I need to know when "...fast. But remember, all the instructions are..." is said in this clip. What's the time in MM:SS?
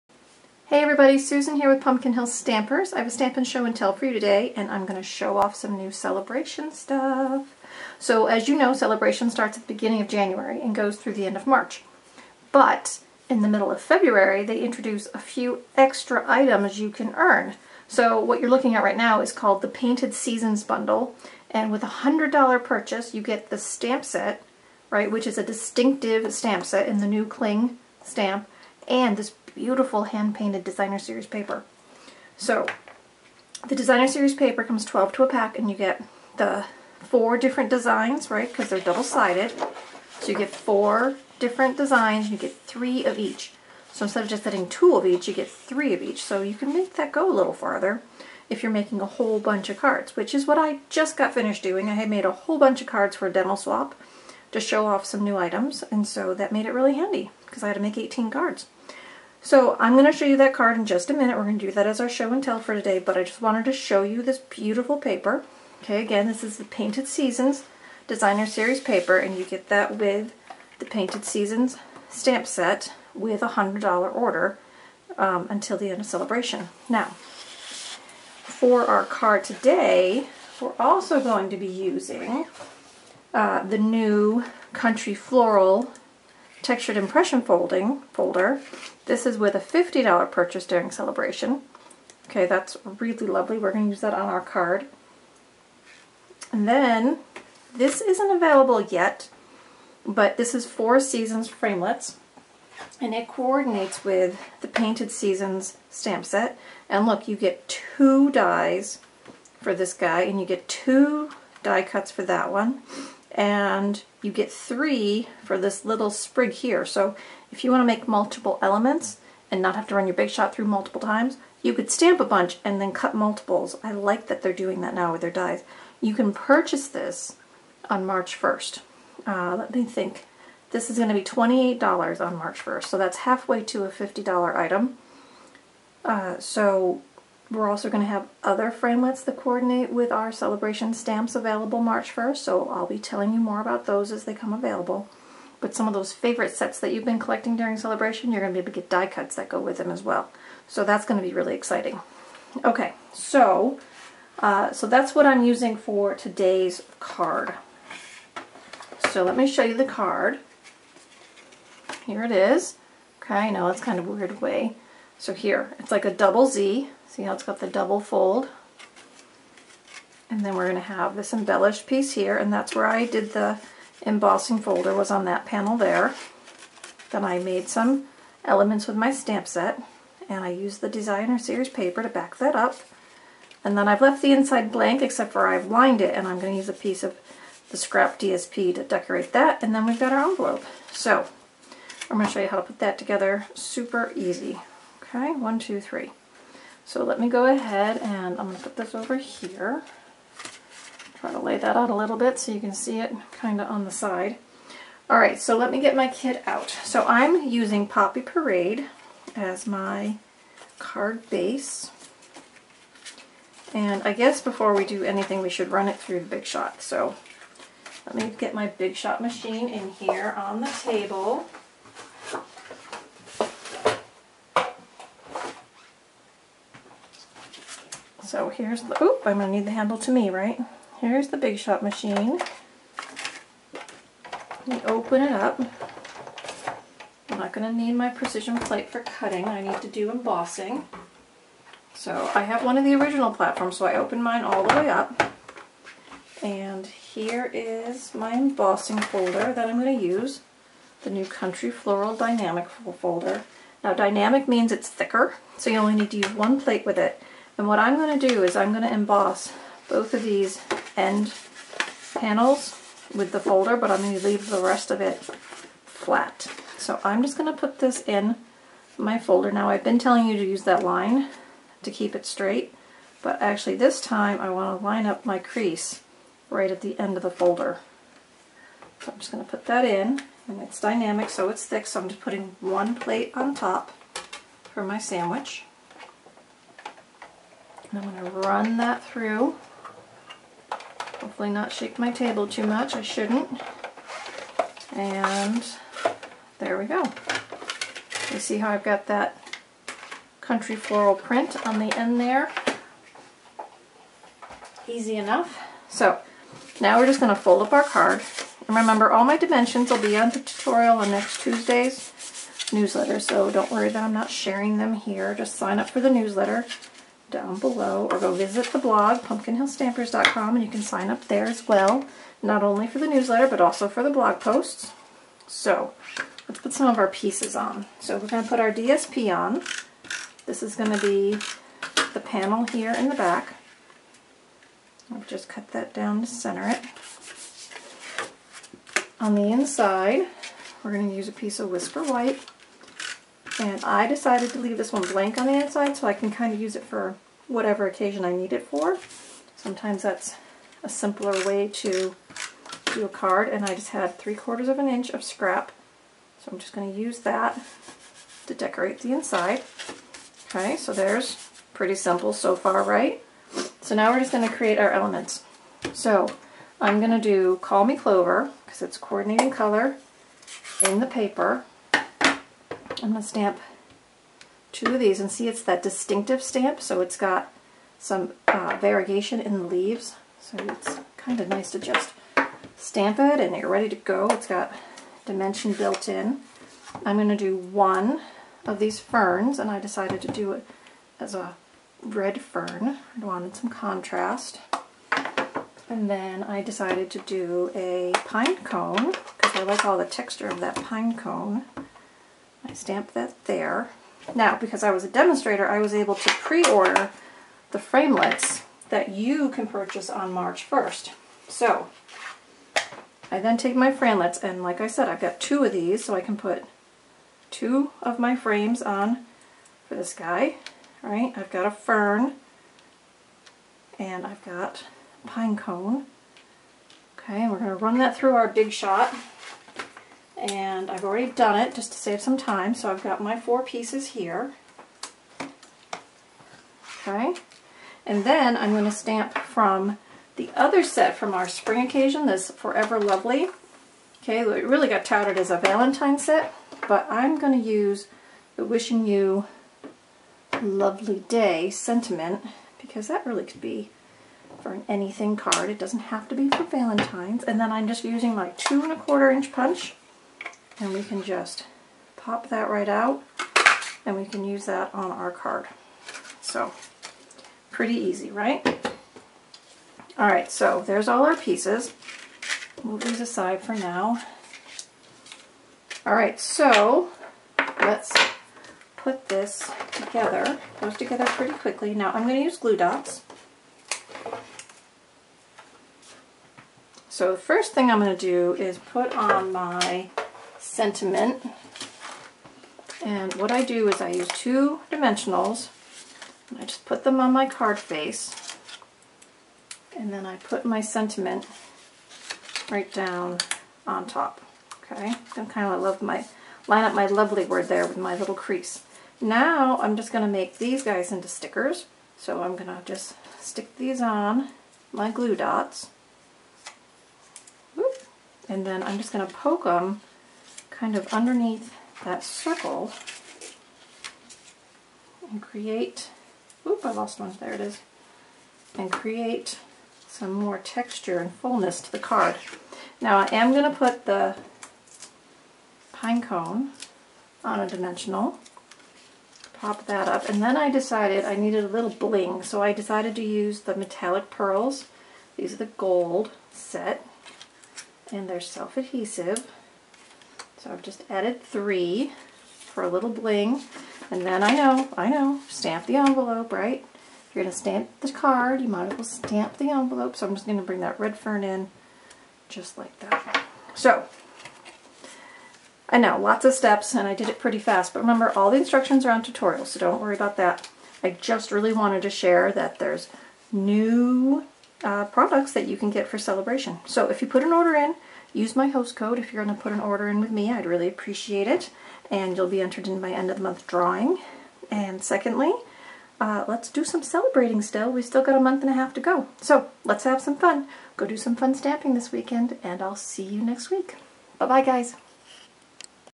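09:27.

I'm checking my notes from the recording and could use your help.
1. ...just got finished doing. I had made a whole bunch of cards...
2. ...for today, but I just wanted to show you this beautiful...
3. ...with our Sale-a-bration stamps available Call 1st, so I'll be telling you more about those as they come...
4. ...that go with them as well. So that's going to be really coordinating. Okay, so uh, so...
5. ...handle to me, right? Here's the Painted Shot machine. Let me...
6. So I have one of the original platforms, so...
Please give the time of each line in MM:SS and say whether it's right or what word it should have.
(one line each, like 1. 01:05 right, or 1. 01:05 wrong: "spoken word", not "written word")
1. 00:50 right
2. 01:02 right
3. 02:19 wrong: "March", not "Call"
4. 02:29 wrong: "exciting", not "coordinating"
5. 03:49 wrong: "Big", not "Painted"
6. 04:01 right.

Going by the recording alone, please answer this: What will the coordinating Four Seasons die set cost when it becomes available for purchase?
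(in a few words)
$28.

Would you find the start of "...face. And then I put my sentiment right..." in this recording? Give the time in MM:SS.
08:17.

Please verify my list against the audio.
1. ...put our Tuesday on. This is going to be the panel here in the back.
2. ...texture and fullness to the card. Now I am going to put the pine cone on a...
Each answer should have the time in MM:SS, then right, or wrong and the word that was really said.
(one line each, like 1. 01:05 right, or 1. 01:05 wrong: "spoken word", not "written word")
1. 05:28 wrong: "DSP", not "Tuesday"
2. 08:50 right.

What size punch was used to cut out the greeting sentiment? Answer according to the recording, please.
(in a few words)
2 1/4 inch.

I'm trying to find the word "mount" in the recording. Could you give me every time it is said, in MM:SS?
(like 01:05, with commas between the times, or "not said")
not said.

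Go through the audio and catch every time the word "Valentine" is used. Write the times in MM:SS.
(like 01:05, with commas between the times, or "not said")
07:25, 07:36.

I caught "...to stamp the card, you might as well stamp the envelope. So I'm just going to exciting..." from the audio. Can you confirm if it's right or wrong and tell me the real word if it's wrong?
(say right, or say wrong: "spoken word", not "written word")
wrong: "bring", not "exciting".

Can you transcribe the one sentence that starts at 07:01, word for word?
All right, I've got a fern, and I've got pine cone.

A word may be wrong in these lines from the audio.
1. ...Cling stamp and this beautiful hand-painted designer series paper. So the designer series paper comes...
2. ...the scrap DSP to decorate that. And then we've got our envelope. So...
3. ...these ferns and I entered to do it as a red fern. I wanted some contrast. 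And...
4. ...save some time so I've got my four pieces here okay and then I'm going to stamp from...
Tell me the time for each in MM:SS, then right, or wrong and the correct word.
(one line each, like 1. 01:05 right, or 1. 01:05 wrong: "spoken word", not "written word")
1. 00:27 right
2. 03:07 right
3. 06:28 wrong: "decided", not "entered"
4. 07:11 right.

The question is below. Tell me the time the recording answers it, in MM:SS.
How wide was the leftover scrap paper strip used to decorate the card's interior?
05:54.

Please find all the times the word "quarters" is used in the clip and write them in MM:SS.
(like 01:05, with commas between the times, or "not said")
05:54, 07:38.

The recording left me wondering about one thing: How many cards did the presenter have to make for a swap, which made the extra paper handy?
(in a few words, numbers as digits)
18.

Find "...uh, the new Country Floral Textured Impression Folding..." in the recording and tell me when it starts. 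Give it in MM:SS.
01:23.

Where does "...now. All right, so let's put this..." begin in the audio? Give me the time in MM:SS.
07:53.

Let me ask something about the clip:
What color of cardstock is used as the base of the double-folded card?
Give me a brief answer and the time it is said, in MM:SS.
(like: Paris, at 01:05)
Poppy Parade, at 03:27.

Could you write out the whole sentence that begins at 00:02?
I have a Stampin' Show and Tell for you today, and I'm going to show off some new Sale-a-bration stuff.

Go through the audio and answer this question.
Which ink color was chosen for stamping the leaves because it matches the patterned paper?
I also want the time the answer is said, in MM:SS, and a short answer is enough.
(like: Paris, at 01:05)
Call Me Clover, at 06:07.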